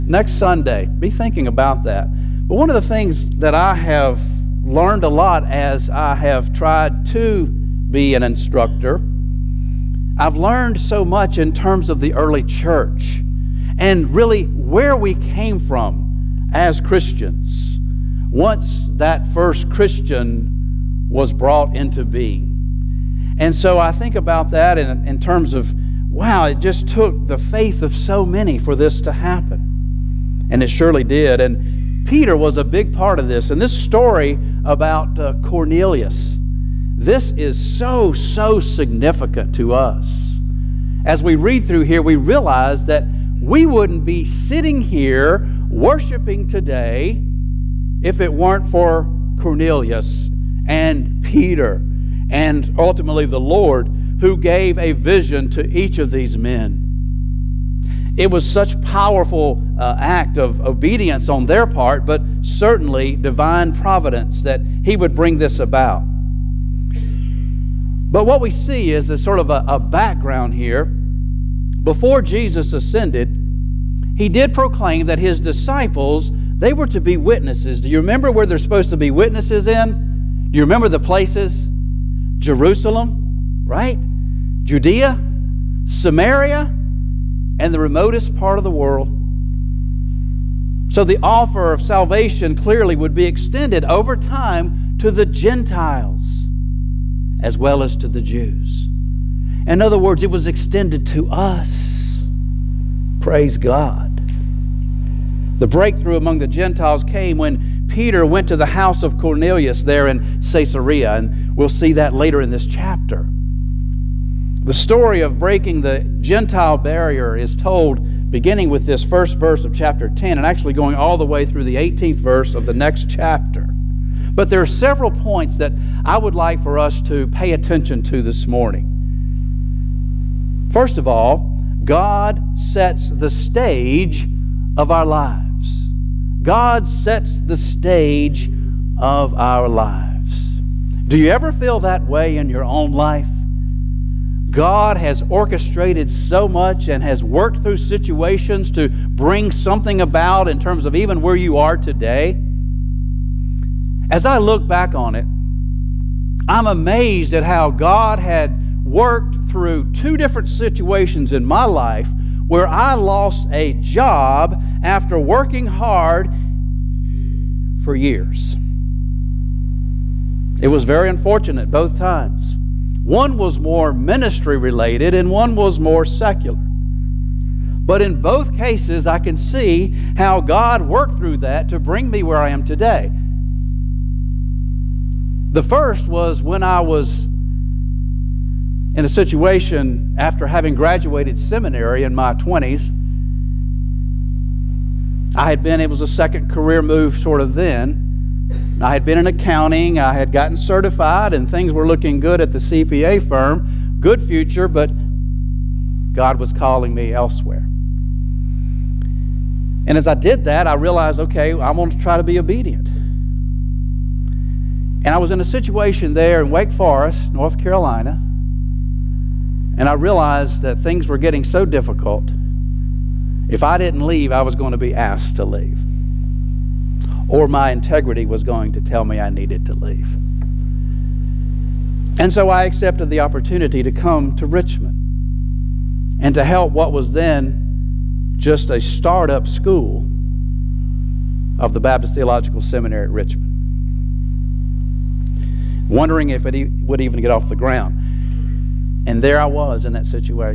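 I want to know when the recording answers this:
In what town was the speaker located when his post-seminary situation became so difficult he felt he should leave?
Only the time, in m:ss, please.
3:36.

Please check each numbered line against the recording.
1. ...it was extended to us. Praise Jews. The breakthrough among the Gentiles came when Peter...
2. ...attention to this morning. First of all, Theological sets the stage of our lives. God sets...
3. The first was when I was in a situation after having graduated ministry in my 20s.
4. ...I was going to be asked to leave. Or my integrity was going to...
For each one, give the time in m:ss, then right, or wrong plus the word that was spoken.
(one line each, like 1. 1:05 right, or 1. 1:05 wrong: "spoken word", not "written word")
1. 1:40 wrong: "God", not "Jews"
2. 2:07 wrong: "God", not "Theological"
3. 3:05 wrong: "seminary", not "ministry"
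4. 3:44 right.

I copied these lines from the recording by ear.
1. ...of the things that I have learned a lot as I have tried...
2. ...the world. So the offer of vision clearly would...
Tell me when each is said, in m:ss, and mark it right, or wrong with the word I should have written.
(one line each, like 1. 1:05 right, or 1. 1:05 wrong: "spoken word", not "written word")
1. 0:02 right
2. 1:28 wrong: "salvation", not "vision".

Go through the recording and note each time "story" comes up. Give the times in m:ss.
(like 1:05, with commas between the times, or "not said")
0:33, 1:54.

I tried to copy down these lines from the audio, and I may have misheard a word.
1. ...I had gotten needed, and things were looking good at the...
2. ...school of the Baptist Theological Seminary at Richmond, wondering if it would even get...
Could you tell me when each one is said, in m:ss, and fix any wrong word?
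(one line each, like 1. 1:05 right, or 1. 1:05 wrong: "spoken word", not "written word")
1. 3:19 wrong: "certified", not "needed"
2. 3:59 right.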